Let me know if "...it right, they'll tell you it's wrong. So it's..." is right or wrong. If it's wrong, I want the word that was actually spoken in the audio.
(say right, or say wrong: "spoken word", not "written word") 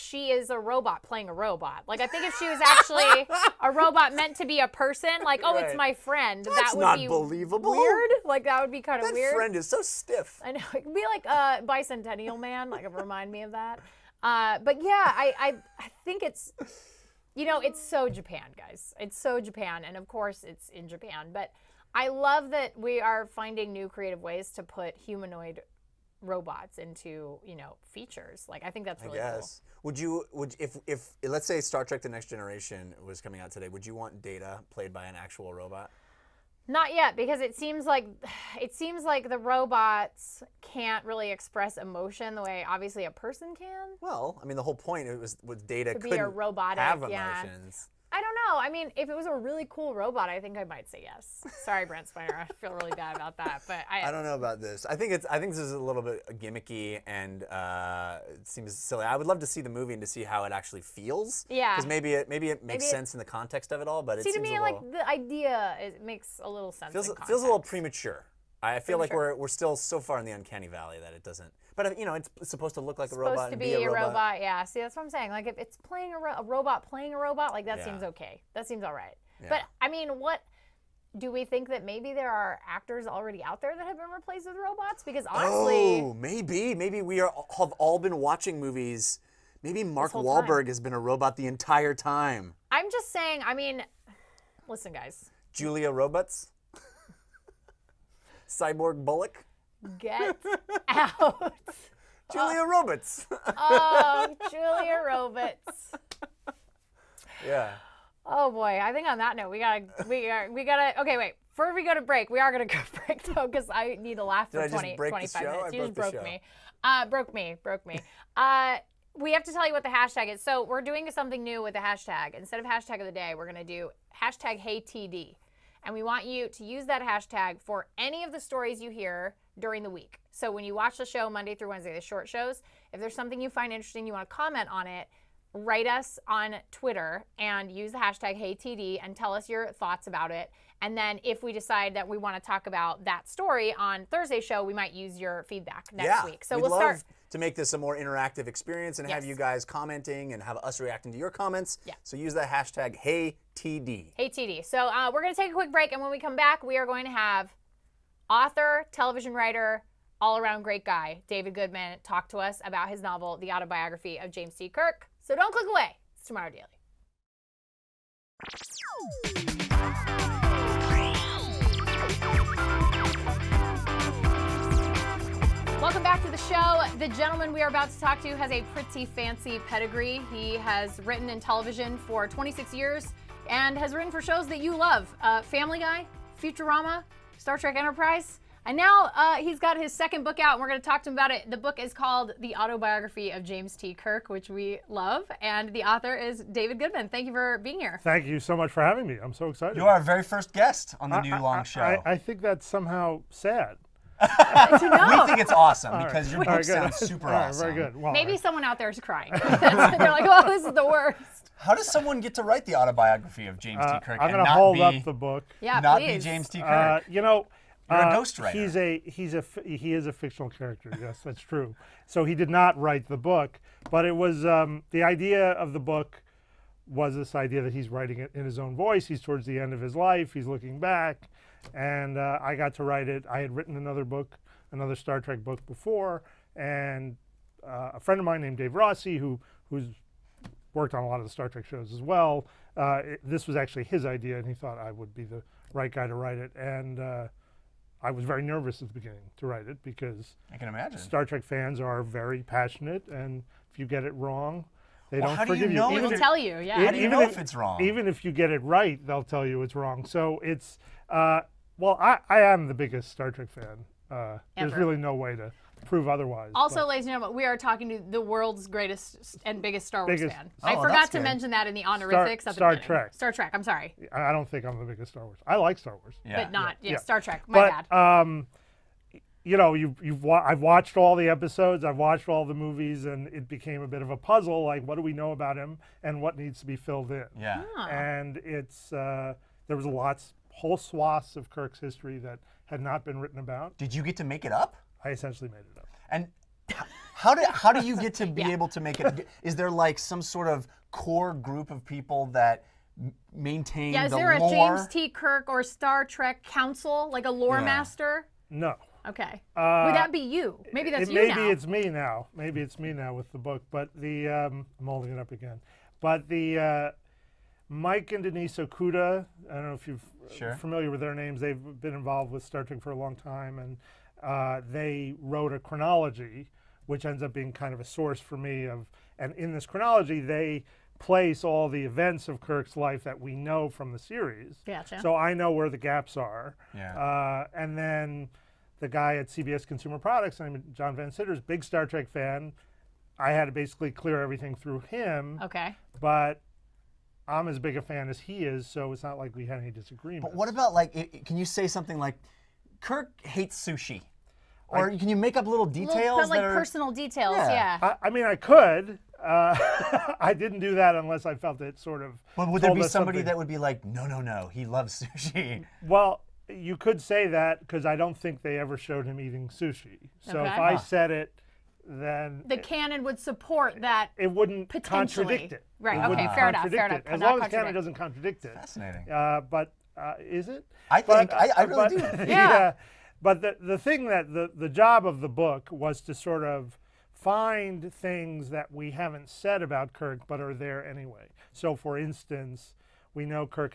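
right.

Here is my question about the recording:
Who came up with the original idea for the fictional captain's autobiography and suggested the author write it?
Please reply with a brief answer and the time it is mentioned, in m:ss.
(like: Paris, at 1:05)
Dave Rossi, at 3:58.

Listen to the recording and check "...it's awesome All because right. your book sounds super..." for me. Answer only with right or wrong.
right.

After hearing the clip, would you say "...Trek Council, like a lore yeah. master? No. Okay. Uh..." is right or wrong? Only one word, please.
right.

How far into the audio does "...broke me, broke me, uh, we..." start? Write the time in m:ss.
1:57.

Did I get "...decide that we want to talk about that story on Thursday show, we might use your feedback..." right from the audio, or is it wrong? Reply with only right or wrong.
right.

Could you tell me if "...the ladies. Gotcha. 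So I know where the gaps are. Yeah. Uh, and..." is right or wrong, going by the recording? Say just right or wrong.
wrong.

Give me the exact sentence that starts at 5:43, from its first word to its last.
I had to basically clear everything through him.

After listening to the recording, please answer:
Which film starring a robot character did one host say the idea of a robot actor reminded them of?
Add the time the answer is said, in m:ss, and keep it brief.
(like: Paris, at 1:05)
Bicentennial Man, at 0:11.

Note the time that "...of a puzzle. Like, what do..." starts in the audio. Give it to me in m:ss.
4:44.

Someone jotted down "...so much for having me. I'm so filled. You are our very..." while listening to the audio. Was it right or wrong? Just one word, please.
wrong.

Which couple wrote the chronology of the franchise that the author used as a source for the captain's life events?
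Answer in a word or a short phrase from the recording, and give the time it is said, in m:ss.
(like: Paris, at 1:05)
Mike and Denise Okuda, at 5:17.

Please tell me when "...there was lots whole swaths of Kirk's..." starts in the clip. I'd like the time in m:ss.
4:49.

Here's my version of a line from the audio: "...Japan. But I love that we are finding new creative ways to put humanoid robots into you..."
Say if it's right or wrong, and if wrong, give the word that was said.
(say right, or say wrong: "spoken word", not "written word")
right.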